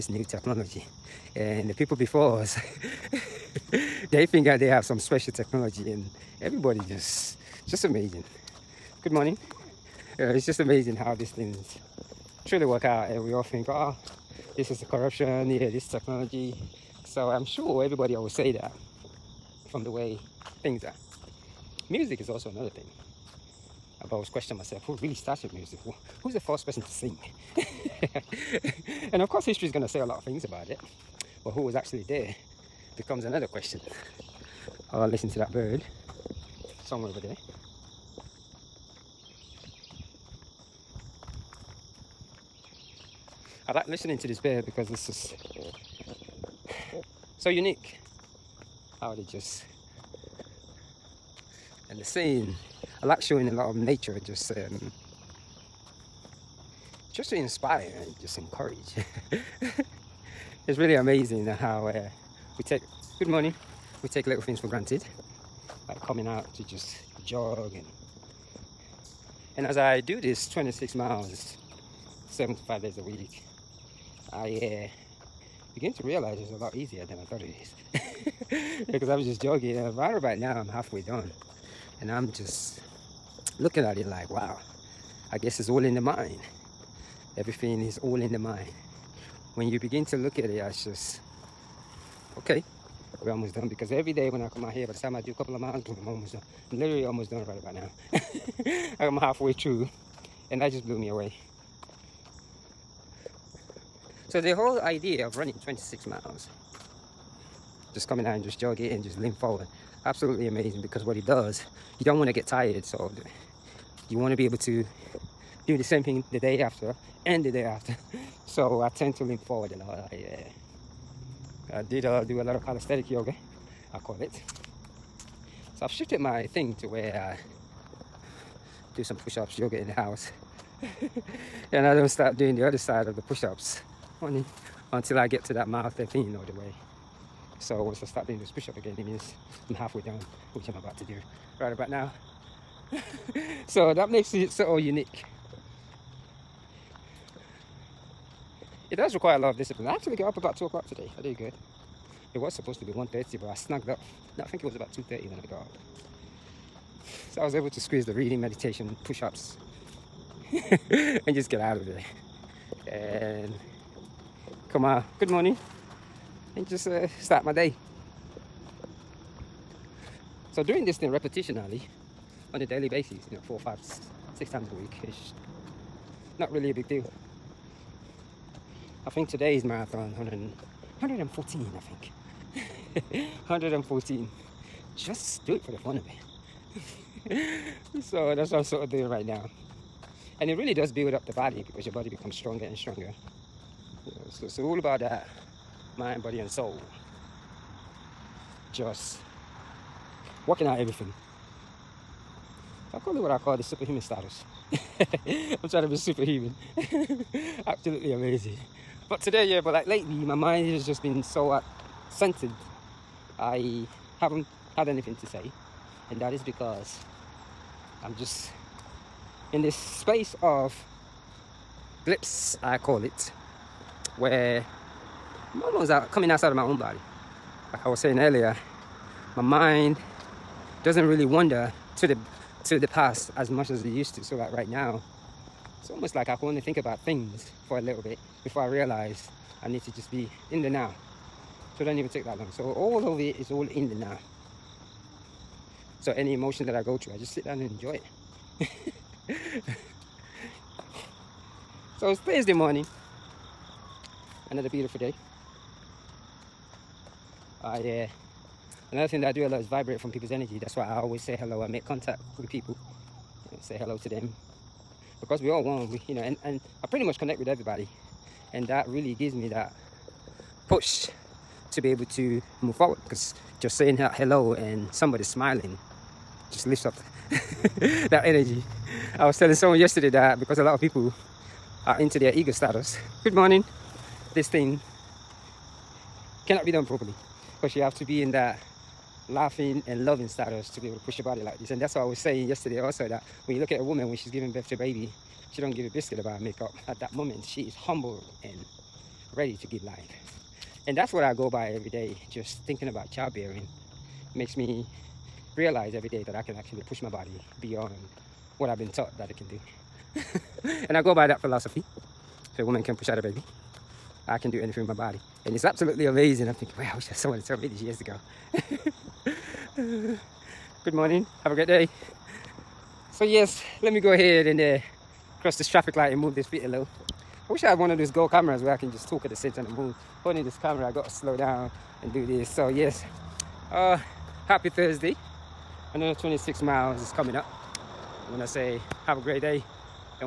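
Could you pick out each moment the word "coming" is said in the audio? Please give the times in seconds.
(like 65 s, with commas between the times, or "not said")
65 s, 108 s, 226 s, 337 s.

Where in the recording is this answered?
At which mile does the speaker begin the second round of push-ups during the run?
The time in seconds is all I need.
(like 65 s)
135 s.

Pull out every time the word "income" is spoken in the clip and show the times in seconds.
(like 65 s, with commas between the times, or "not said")
not said.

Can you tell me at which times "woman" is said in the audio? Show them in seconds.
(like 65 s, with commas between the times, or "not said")
293 s, 312 s.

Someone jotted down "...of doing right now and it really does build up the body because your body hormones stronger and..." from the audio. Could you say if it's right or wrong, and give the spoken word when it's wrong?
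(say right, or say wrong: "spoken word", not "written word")
wrong: "becomes", not "hormones".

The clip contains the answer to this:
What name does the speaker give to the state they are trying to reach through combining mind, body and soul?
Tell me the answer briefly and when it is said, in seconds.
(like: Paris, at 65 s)
superhuman status, at 203 s.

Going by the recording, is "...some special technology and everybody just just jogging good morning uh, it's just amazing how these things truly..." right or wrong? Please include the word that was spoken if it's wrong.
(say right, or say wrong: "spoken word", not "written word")
wrong: "amazing", not "jogging".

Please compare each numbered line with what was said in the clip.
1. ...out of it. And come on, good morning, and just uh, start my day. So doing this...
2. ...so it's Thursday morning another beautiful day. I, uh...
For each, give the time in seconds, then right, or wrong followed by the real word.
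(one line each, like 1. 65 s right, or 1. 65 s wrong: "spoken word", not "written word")
1. 161 s right
2. 251 s right.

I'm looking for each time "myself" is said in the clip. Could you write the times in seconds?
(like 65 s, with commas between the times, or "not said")
24 s.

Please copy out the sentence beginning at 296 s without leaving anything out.
At that moment, she is humbled and ready to give life.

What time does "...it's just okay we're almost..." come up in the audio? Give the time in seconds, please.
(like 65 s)
90 s.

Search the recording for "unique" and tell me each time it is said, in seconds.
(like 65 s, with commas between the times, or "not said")
47 s, 144 s.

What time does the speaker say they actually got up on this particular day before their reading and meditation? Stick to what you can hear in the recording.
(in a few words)
2 o'clock.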